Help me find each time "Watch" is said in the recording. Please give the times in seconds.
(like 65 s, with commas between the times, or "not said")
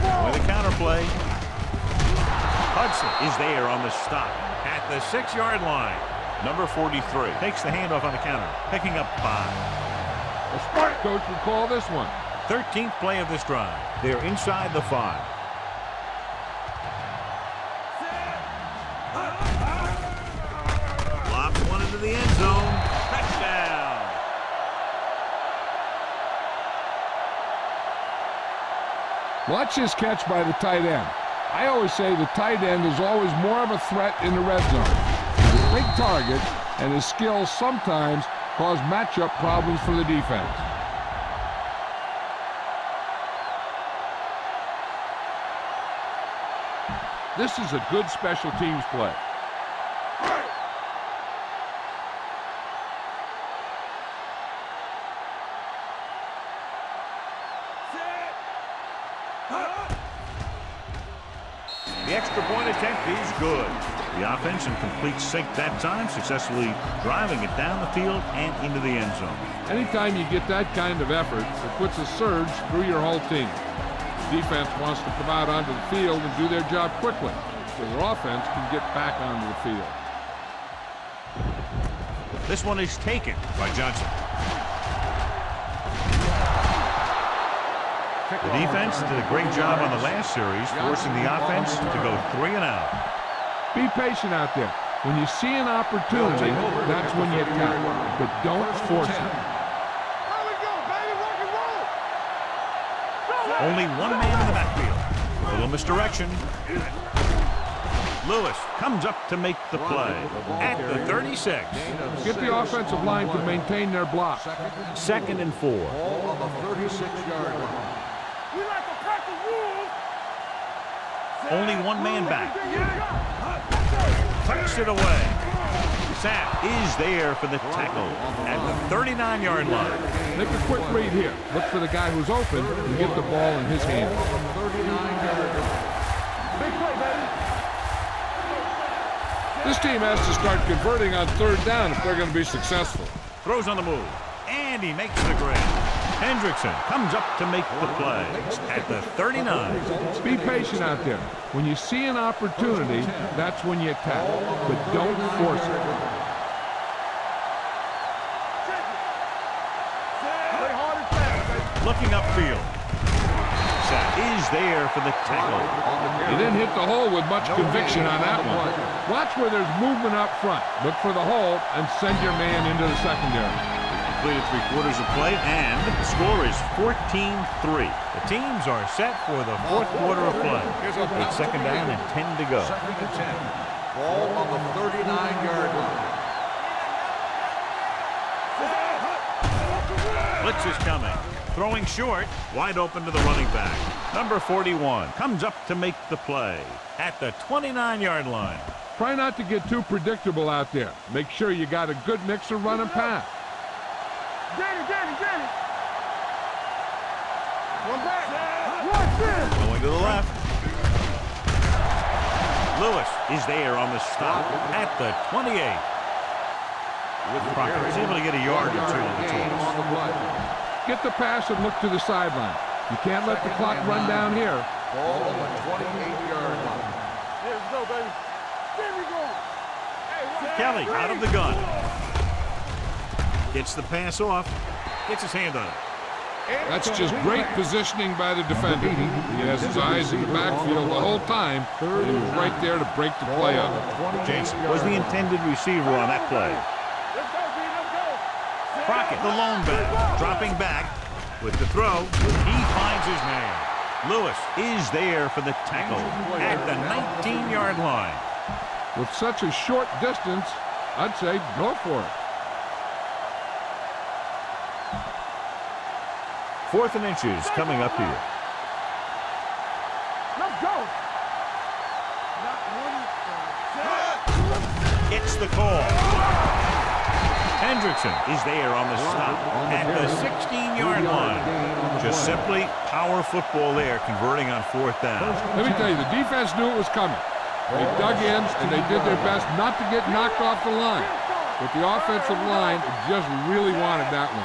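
29 s, 169 s.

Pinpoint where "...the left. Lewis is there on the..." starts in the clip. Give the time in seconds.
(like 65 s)
209 s.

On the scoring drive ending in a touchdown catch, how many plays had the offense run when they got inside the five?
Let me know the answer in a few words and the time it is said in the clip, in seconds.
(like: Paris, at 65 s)
13, at 12 s.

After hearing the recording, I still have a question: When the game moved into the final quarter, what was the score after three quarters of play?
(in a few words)
14-3.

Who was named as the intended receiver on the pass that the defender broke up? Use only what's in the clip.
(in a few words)
Jason.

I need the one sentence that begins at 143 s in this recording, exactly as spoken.
Throws on the move, and he makes the grab.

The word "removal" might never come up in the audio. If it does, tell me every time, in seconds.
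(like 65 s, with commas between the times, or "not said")
not said.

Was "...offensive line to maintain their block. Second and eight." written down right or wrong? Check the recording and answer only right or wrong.
wrong.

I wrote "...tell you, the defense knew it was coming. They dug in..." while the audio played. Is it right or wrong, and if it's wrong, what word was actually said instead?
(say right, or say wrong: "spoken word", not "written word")
right.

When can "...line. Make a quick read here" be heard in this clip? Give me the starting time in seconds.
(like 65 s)
129 s.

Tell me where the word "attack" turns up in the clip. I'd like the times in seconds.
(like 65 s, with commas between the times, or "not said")
97 s, 153 s.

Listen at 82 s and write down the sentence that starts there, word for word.
This one is taken by Johnson.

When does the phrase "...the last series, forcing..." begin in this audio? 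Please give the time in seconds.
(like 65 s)
89 s.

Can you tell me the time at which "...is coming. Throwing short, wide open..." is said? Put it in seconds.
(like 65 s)
190 s.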